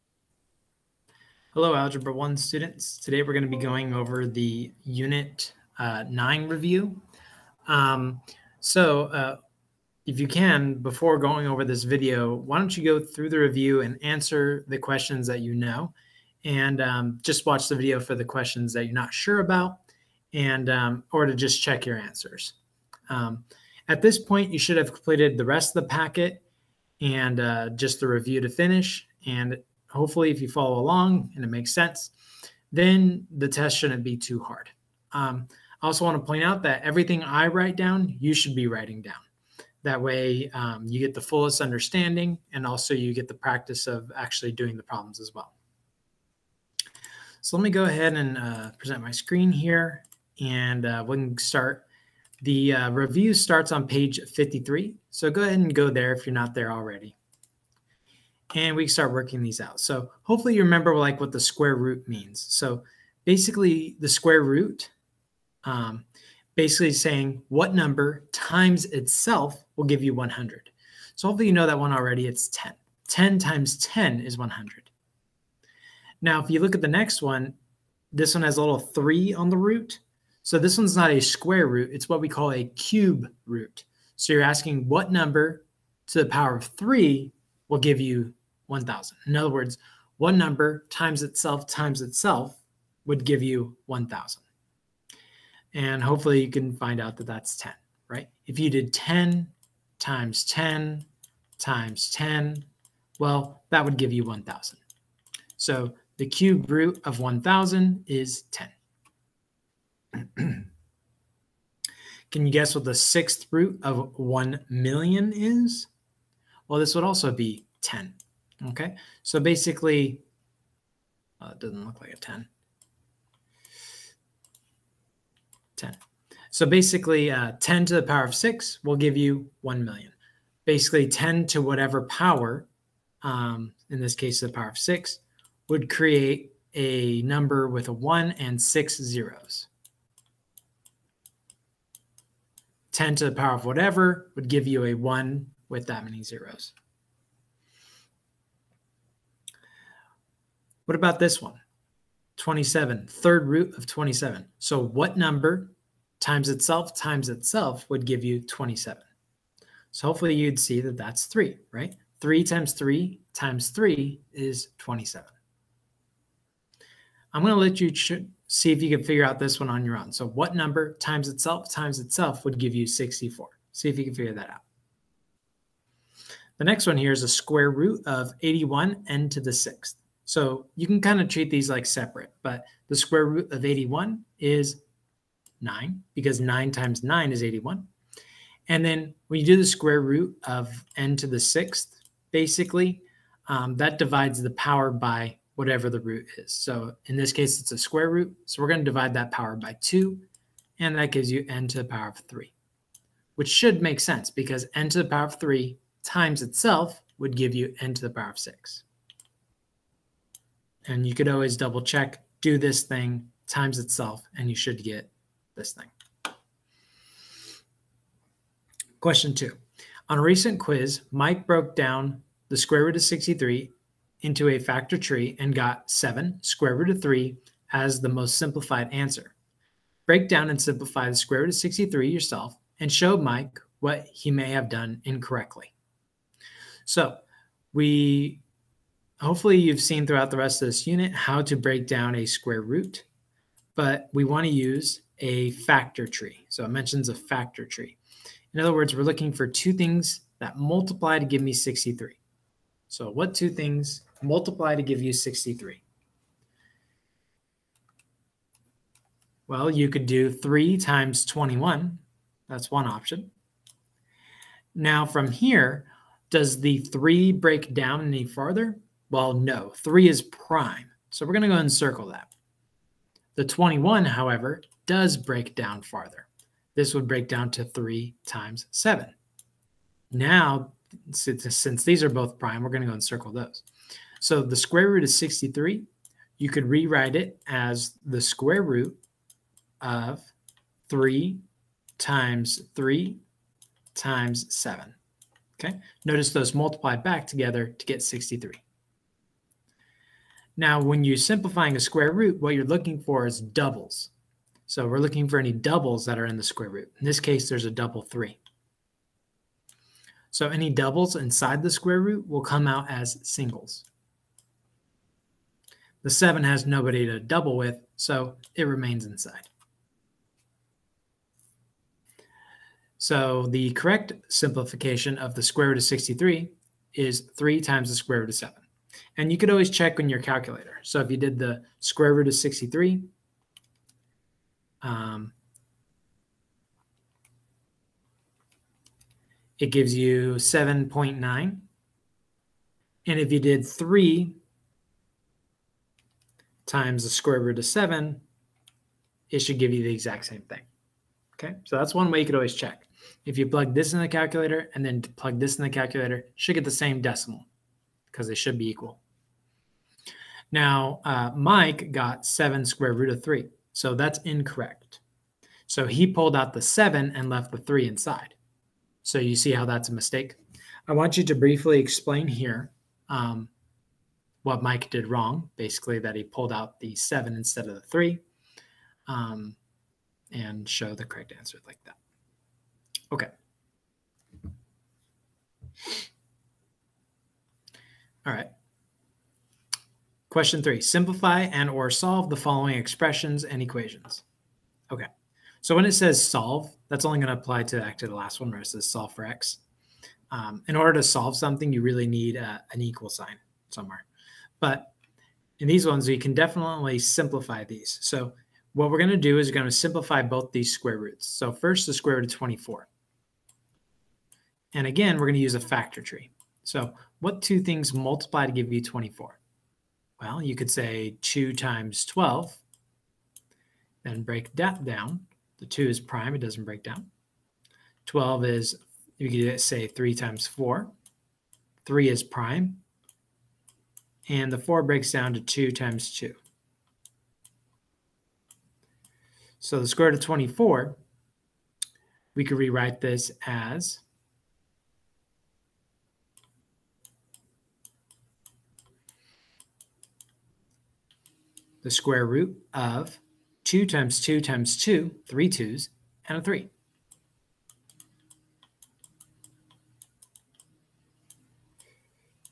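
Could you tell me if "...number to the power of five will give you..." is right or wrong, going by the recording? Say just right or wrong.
wrong.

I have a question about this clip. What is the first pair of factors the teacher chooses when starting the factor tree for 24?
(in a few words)
2 times 12.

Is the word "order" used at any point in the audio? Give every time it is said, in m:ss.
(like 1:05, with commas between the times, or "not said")
6:40.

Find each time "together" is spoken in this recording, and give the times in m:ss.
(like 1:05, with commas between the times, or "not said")
4:57.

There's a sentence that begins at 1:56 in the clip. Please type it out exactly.
Well, this would also be 10.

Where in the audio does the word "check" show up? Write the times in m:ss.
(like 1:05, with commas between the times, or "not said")
0:21, 3:31, 5:29, 5:52.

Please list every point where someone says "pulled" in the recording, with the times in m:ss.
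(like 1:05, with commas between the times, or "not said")
6:06, 6:16.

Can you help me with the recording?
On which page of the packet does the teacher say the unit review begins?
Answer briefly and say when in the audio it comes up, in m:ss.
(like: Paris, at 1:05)
53, at 0:53.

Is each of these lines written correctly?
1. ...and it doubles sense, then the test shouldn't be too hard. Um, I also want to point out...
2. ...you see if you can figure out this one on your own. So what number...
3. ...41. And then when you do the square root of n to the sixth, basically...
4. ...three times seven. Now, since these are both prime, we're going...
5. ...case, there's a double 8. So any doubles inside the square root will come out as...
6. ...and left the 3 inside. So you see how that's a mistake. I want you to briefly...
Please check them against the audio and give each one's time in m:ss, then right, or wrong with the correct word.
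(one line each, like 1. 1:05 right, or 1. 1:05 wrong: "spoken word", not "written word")
1. 0:31 wrong: "makes", not "doubles"
2. 2:47 right
3. 3:07 wrong: "81", not "41"
4. 4:37 right
5. 5:07 wrong: "3", not "8"
6. 6:07 right.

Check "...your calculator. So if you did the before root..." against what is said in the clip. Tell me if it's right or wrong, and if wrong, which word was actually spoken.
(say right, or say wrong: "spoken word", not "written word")
wrong: "square", not "before".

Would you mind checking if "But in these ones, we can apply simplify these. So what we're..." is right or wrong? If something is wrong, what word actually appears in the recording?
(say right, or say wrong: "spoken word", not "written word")
wrong: "definitely", not "apply".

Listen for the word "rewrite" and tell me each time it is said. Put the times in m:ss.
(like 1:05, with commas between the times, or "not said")
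4:46, 7:22.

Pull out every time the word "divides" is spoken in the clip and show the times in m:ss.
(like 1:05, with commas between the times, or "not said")
3:13, 3:18.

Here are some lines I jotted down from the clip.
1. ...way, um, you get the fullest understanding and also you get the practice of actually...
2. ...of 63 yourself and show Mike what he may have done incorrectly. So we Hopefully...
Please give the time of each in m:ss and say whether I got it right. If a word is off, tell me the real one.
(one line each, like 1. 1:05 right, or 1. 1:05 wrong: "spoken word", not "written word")
1. 0:40 right
2. 3:51 right.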